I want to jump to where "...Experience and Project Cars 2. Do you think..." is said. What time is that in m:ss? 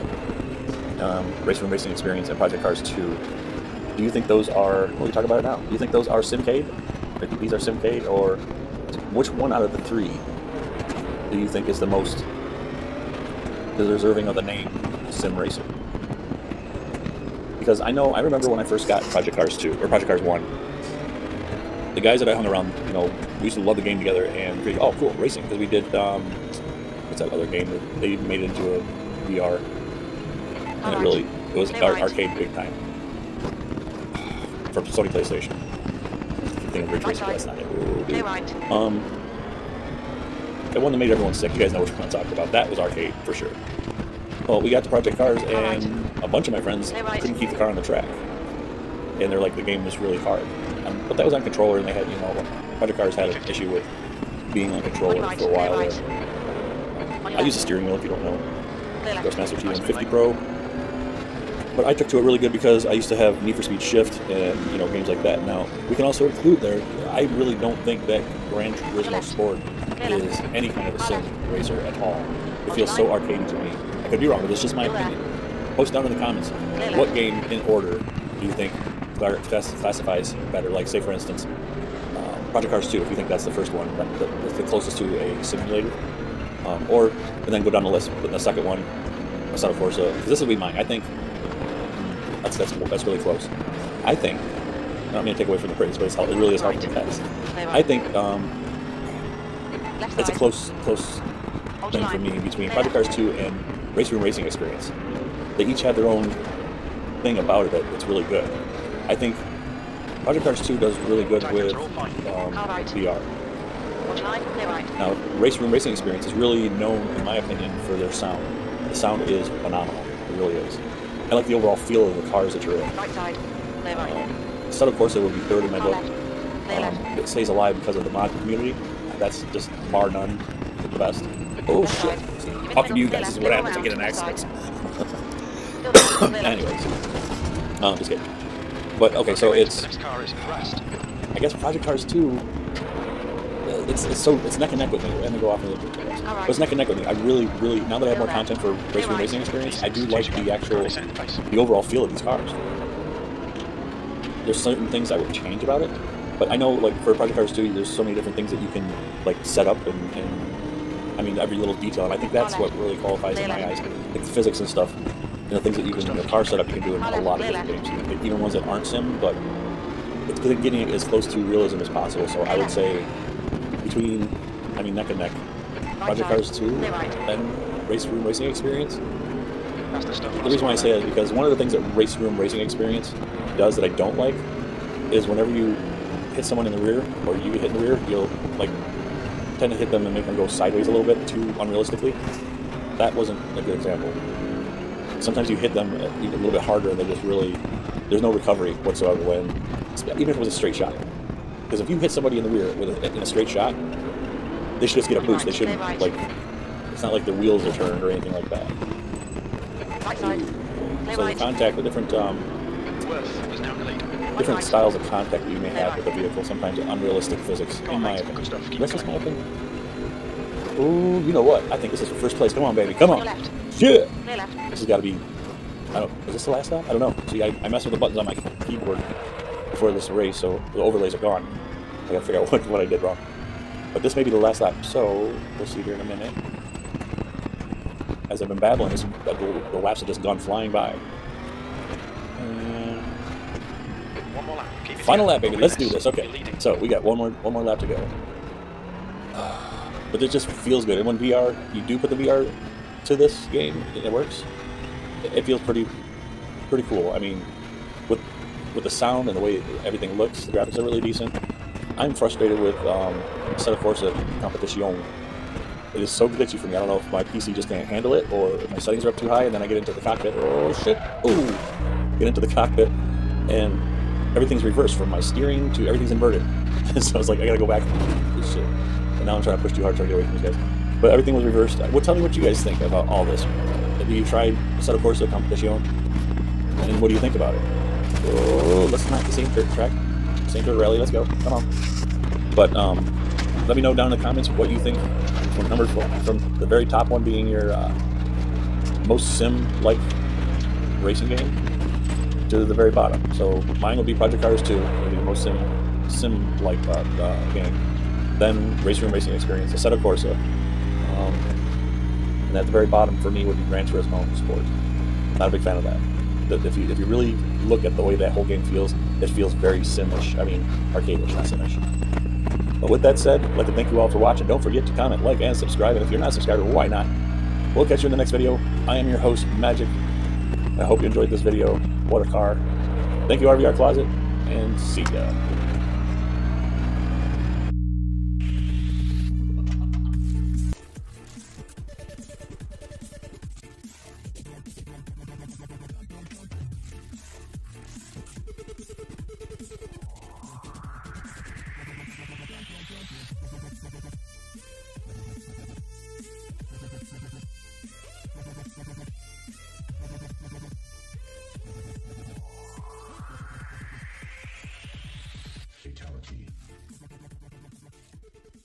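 0:01.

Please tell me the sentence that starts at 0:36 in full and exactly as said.
I keep thinking of Ridge Racer, but that's not Clear right.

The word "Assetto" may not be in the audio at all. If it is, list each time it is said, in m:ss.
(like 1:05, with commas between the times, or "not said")
1:29, 4:44, 5:09.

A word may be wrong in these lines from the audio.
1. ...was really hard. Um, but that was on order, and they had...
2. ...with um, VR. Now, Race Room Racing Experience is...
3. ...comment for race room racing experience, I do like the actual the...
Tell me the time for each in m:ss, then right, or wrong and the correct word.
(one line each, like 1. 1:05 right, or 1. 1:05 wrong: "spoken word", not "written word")
1. 0:49 wrong: "controller", not "order"
2. 1:51 right
3. 2:28 wrong: "content", not "comment".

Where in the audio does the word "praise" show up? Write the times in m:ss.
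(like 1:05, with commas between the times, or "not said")
1:35.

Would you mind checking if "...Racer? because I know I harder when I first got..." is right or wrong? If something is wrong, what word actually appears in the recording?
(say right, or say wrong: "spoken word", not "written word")
wrong: "remember", not "harder".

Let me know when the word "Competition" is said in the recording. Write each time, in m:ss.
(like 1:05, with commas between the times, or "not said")
4:24, 4:45.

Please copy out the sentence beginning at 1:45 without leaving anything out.
They each have their own thing about it that it's really good.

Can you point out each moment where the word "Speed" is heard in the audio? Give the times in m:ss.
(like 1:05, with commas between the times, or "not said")
1:03.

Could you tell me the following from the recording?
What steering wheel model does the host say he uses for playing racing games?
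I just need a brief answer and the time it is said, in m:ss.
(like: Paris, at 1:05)
Thrustmaster T150 Pro, at 0:59.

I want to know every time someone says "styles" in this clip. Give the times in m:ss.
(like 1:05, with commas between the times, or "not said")
3:34.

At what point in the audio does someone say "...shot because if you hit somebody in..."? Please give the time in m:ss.
3:20.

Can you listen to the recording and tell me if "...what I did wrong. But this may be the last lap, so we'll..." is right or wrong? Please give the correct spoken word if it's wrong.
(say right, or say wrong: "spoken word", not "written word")
right.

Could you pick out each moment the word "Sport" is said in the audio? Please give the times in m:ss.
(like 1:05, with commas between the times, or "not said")
1:09, 5:14.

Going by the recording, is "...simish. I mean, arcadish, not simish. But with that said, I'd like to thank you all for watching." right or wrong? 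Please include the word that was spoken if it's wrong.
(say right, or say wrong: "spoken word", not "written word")
right.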